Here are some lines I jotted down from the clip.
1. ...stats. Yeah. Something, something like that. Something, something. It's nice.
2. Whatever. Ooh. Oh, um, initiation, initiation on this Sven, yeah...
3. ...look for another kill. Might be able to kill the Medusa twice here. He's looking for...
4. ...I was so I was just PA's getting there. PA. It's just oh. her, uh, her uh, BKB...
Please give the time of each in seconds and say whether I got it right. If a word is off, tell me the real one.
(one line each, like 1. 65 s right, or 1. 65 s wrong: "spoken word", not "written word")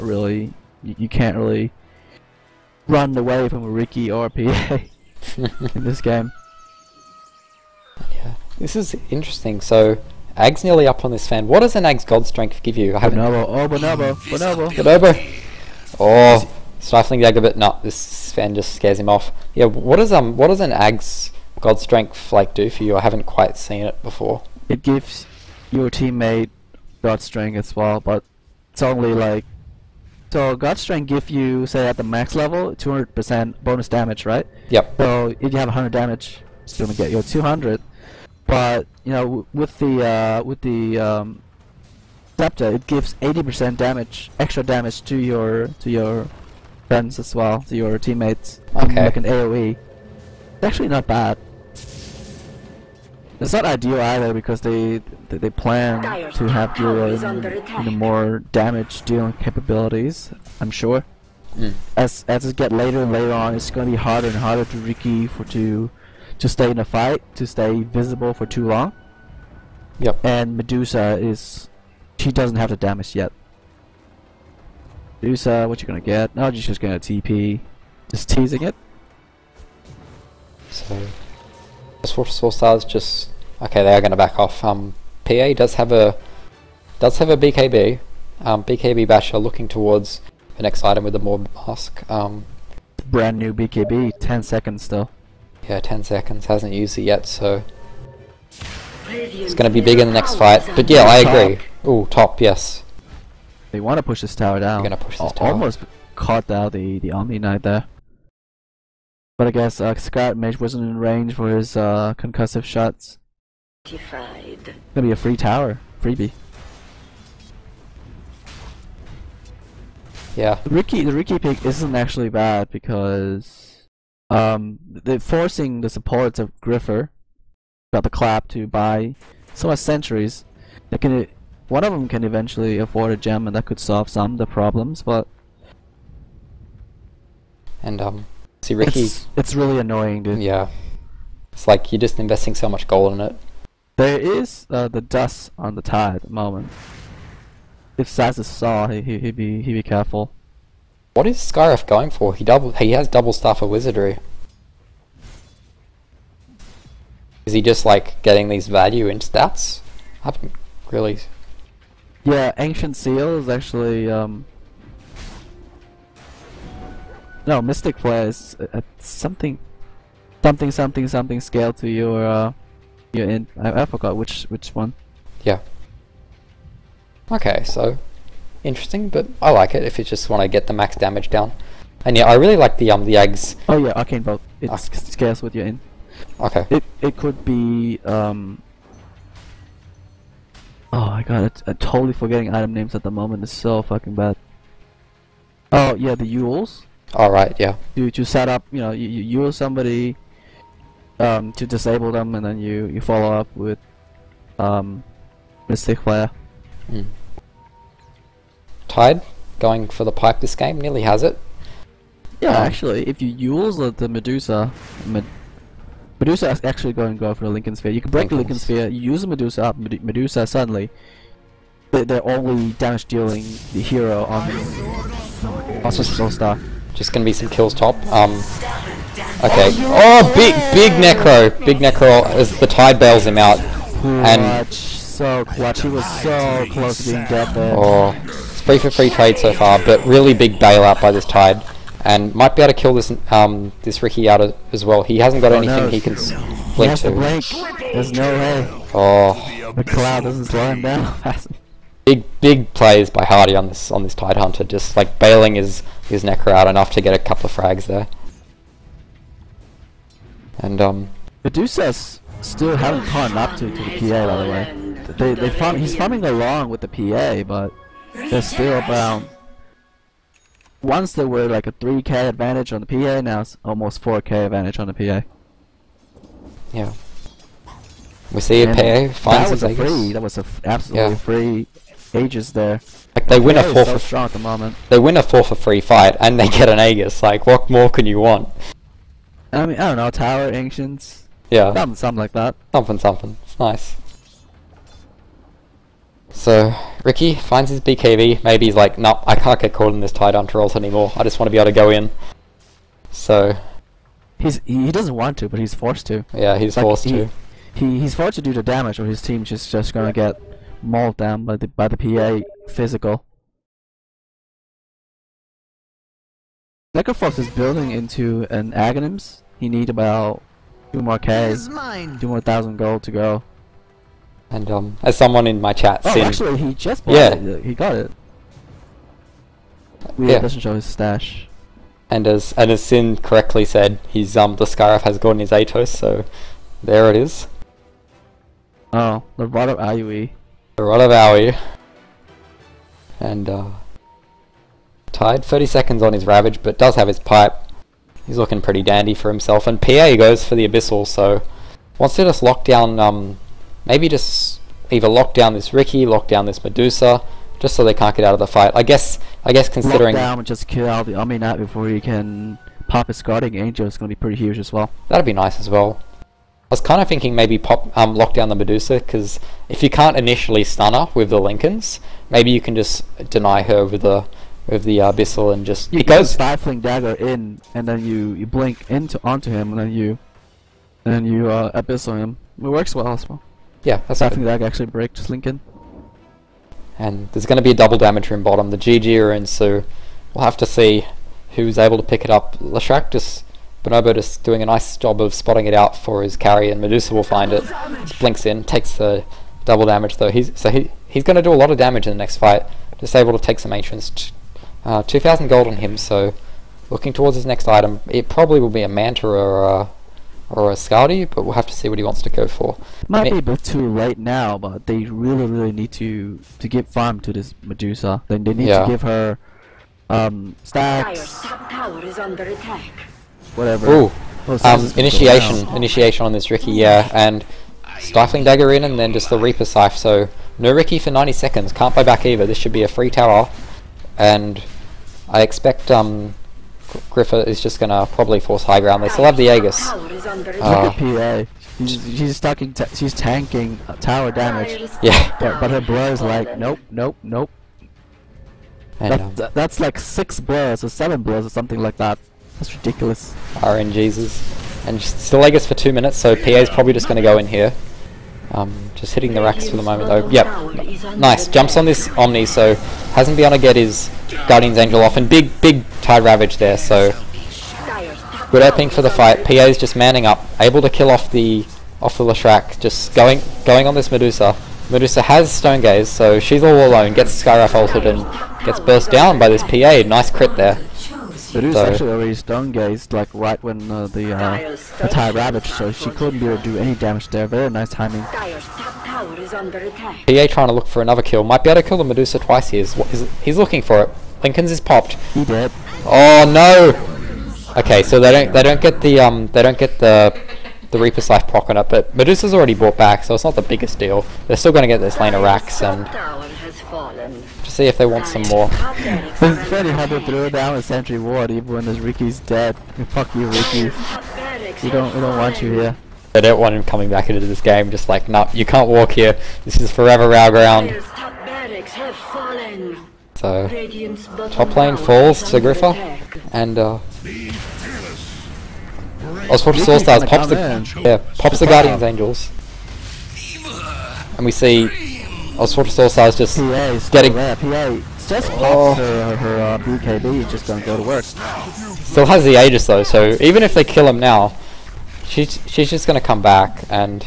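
1. 290 s wrong: "ancients", not "stats"
2. 423 s wrong: "Riki", not "Sven"
3. 490 s right
4. 535 s right.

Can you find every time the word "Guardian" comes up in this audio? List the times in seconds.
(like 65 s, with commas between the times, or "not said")
363 s, 464 s, 531 s.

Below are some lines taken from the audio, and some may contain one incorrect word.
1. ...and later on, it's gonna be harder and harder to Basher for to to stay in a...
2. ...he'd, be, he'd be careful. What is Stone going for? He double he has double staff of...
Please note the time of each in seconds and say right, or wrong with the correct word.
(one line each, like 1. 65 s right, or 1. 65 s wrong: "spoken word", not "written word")
1. 63 s wrong: "Riki", not "Basher"
2. 149 s wrong: "Skywrath", not "Stone".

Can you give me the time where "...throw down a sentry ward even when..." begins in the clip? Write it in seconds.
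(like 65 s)
510 s.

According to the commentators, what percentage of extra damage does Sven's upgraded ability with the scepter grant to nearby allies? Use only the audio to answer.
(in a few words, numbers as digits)
80%.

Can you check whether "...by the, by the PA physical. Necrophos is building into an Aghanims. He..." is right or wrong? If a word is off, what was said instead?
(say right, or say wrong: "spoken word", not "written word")
right.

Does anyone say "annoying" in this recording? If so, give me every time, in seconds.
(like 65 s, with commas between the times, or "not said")
139 s.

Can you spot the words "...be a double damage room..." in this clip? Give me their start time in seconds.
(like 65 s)
387 s.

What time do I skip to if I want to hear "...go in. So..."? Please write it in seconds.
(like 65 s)
301 s.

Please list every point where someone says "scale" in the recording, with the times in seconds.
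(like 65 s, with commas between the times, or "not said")
171 s, 184 s.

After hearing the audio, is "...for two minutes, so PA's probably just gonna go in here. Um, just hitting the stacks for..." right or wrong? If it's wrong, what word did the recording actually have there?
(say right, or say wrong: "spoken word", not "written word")
wrong: "racks", not "stacks".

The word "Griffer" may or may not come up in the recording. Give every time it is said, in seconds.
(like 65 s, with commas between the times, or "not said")
126 s, 437 s, 525 s.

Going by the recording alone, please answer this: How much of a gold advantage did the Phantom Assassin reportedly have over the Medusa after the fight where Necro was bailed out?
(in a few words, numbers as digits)
4k.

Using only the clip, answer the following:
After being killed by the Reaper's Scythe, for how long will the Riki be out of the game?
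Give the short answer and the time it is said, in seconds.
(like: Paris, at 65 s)
90 seconds, at 431 s.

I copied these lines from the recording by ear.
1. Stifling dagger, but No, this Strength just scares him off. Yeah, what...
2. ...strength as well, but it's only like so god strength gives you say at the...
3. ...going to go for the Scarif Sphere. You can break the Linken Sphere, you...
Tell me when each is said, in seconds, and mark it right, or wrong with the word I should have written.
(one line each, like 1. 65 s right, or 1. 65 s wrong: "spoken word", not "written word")
1. 16 s wrong: "Sven", not "Strength"
2. 27 s right
3. 216 s wrong: "Linken", not "Scarif".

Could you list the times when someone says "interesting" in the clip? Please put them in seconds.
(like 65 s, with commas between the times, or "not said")
9 s, 178 s.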